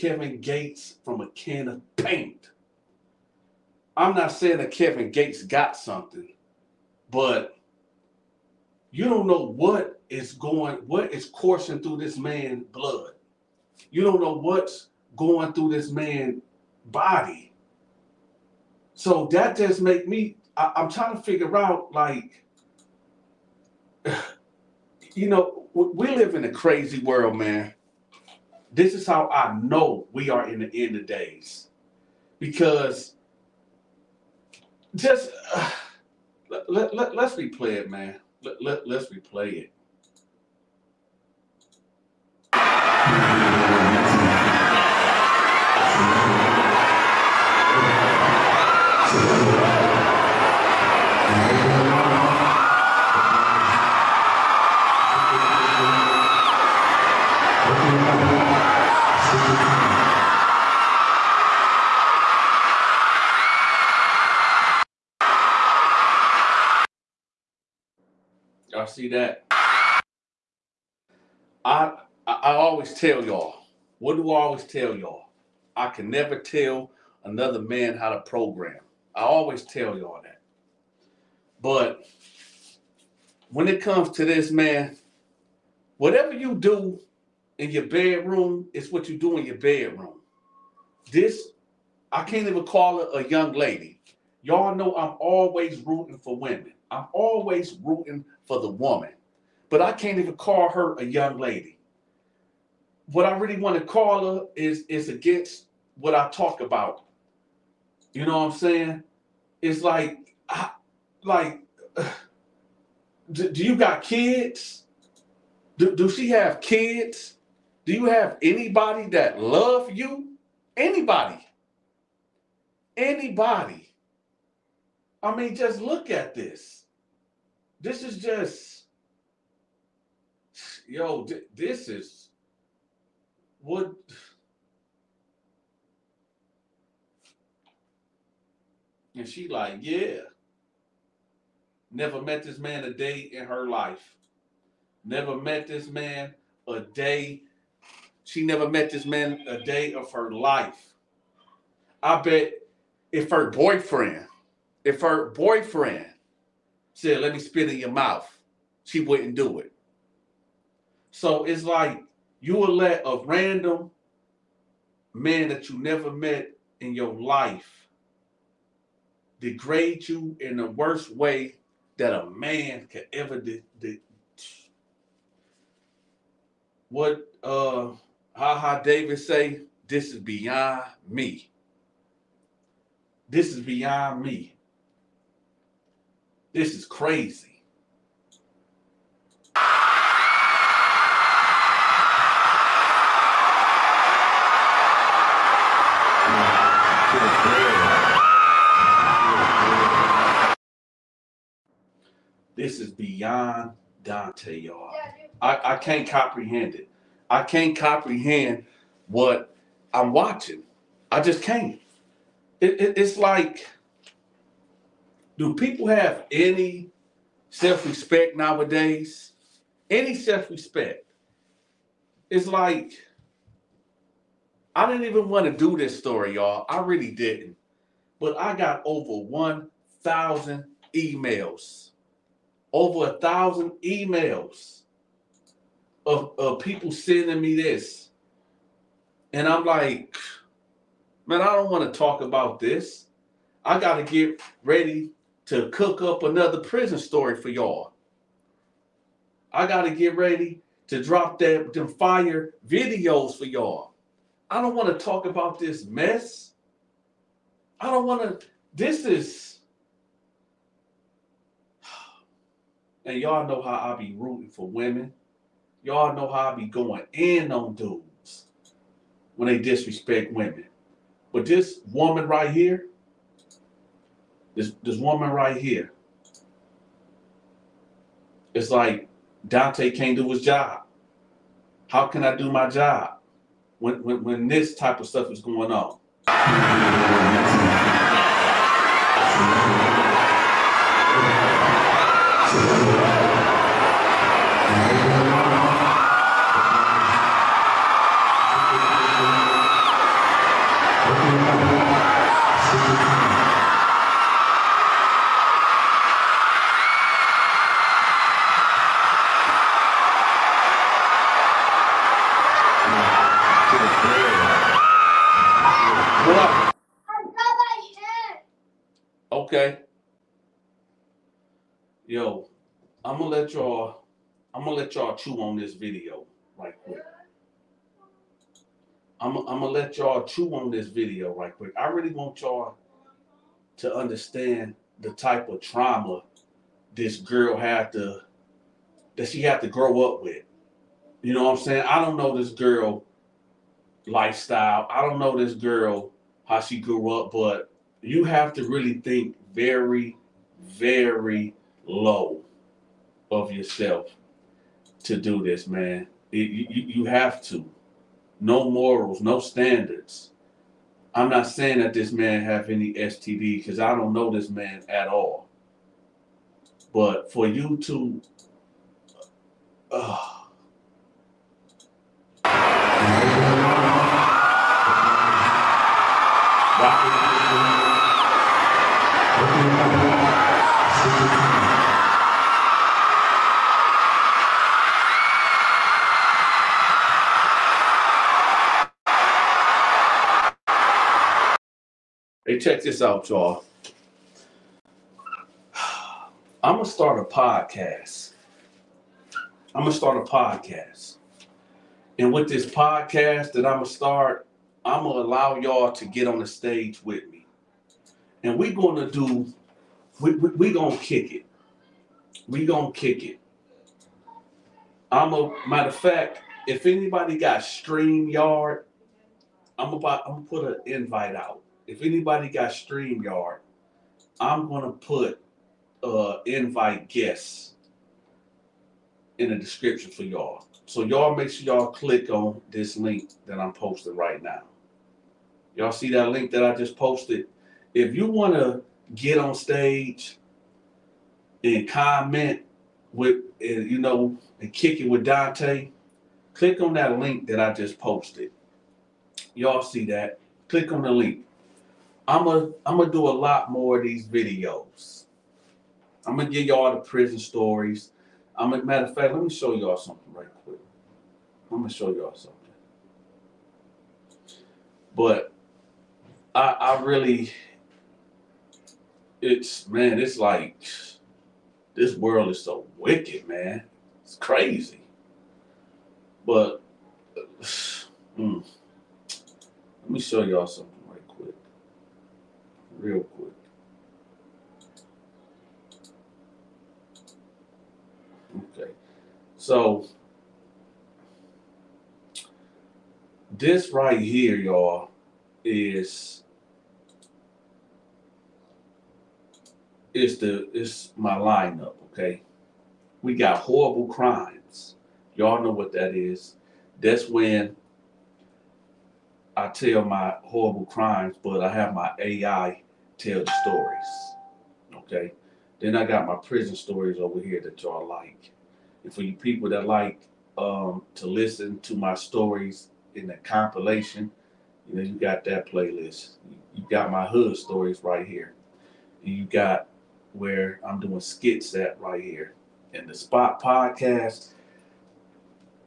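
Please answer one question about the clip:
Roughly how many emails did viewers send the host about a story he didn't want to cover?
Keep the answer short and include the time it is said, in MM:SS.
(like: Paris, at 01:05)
1,000, at 03:49.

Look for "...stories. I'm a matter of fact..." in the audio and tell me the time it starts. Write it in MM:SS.
07:37.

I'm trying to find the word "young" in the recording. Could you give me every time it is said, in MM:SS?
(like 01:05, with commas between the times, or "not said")
01:33, 01:41.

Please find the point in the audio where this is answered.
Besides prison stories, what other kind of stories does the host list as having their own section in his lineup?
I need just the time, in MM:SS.
08:47.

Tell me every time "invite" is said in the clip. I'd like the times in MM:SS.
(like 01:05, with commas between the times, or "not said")
07:00, 07:06.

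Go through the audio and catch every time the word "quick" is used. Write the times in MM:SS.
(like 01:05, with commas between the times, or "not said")
05:26, 05:31, 07:40, 08:03.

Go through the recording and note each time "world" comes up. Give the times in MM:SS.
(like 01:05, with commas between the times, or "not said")
00:26, 07:52.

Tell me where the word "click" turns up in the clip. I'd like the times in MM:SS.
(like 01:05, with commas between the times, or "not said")
07:11, 07:26, 07:30.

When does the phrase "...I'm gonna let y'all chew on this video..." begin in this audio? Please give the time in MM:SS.
05:29.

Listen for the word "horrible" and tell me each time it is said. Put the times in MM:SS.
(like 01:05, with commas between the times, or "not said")
08:23, 08:30.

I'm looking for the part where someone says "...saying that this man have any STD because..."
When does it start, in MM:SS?
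06:01.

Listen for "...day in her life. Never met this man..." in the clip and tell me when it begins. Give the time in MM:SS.
02:22.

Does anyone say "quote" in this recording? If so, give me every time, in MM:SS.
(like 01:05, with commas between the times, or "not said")
not said.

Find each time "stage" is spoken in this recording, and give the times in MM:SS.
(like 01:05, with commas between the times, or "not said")
06:46, 07:19.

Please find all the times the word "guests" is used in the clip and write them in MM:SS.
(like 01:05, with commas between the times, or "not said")
07:07.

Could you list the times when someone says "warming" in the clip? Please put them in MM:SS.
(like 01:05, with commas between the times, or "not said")
not said.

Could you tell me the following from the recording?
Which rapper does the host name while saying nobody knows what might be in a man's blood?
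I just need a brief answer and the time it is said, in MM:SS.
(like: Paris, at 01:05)
Kevin Gates, at 00:04.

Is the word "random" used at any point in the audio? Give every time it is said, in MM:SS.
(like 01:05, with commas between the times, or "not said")
02:43.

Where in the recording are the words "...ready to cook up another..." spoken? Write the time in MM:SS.
04:04.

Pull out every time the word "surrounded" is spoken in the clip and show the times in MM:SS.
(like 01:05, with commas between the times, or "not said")
not said.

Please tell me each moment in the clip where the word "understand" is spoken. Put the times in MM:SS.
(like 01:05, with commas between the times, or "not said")
05:33.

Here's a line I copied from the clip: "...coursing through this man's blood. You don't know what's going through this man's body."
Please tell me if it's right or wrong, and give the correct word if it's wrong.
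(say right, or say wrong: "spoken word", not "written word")
right.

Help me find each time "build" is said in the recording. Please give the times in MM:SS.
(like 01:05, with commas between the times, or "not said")
not said.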